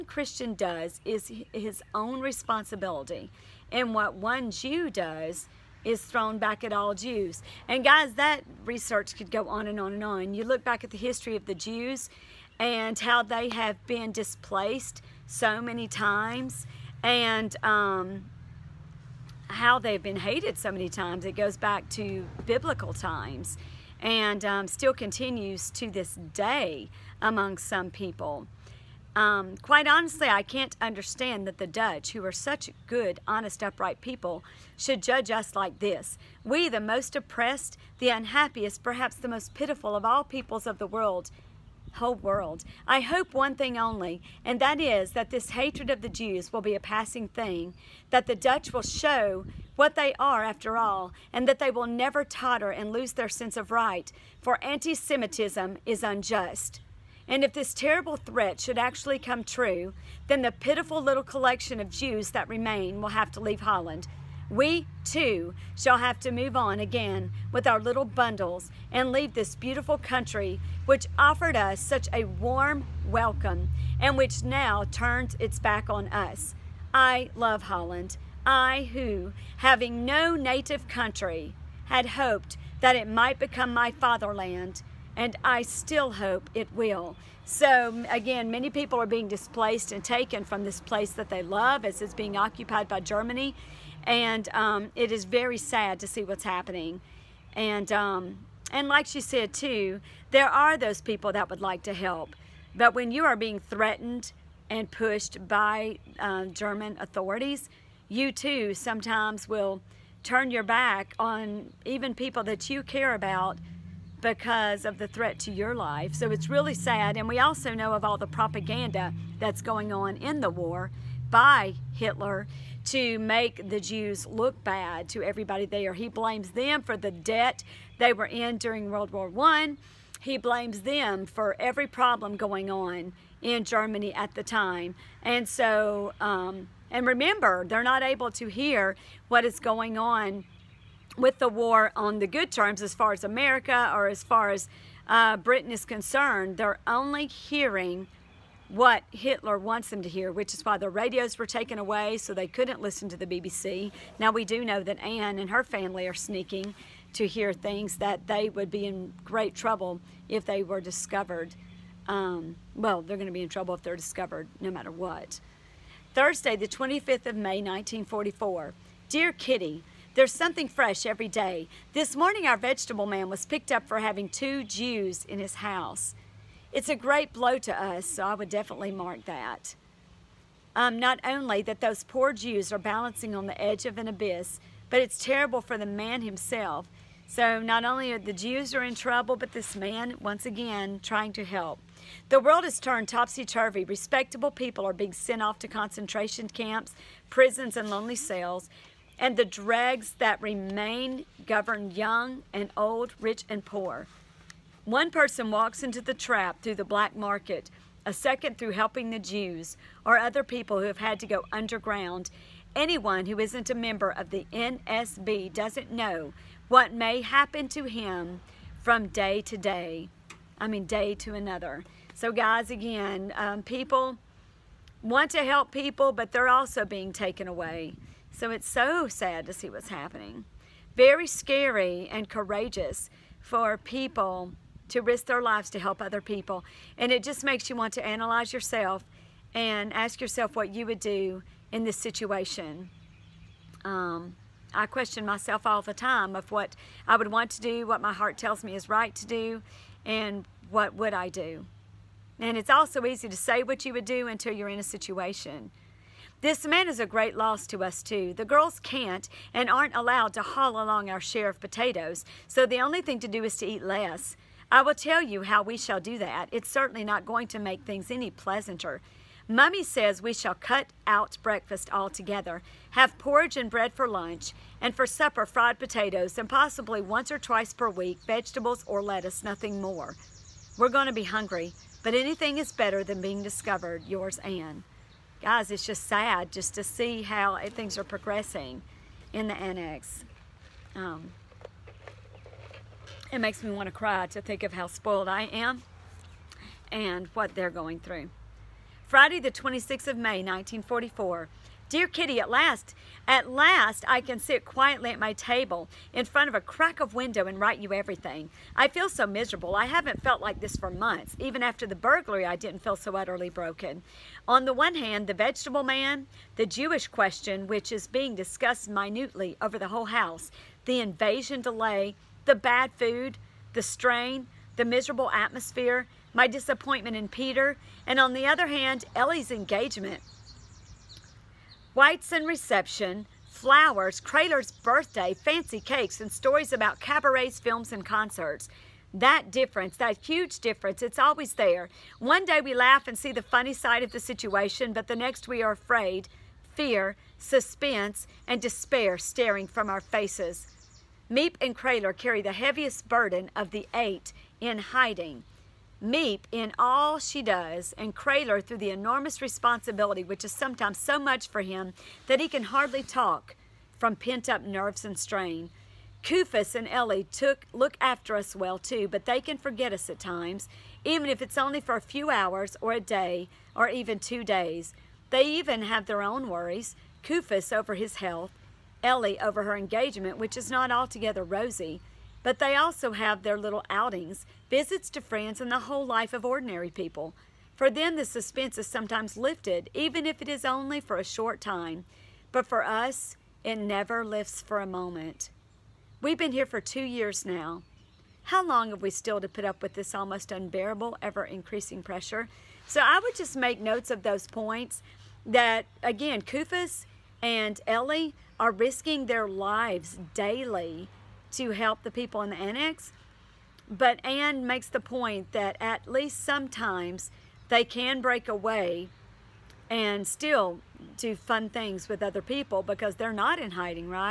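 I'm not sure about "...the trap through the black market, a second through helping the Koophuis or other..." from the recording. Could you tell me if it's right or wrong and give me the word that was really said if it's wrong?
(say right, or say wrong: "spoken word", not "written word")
wrong: "Jews", not "Koophuis".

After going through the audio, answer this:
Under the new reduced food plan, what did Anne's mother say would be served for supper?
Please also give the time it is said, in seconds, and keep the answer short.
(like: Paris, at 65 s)
fried potatoes, at 275 s.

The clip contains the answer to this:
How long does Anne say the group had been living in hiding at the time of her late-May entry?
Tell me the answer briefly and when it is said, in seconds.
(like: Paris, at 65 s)
2 years, at 396 s.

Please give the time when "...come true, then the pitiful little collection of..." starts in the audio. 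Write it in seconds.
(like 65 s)
59 s.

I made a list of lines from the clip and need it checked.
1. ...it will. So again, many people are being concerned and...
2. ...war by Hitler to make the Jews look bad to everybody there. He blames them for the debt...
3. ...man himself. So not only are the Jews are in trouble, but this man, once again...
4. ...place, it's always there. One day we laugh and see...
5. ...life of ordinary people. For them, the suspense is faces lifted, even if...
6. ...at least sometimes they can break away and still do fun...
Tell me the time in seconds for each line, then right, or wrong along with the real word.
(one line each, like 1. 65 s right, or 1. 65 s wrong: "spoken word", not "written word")
1. 86 s wrong: "displaced", not "concerned"
2. 120 s right
3. 185 s right
4. 340 s wrong: "difference", not "place"
5. 386 s wrong: "sometimes", not "faces"
6. 415 s right.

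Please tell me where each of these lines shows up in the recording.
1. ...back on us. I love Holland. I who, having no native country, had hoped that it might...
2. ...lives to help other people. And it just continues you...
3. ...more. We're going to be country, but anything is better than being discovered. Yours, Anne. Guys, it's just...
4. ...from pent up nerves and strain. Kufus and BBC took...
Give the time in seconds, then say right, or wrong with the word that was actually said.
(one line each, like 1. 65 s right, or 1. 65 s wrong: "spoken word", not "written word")
1. 75 s right
2. 235 s wrong: "makes", not "continues"
3. 279 s wrong: "hungry", not "country"
4. 363 s wrong: "Ellie", not "BBC".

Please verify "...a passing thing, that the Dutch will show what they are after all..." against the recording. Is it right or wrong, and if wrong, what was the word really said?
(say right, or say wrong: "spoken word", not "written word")
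right.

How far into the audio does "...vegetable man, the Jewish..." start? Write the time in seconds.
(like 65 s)
315 s.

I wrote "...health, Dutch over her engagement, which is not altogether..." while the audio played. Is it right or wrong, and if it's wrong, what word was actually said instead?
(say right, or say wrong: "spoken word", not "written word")
wrong: "Ellie", not "Dutch".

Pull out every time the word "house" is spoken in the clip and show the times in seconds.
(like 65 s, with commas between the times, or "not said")
175 s, 320 s.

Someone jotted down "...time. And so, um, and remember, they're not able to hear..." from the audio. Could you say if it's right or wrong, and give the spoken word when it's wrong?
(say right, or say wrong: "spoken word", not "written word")
right.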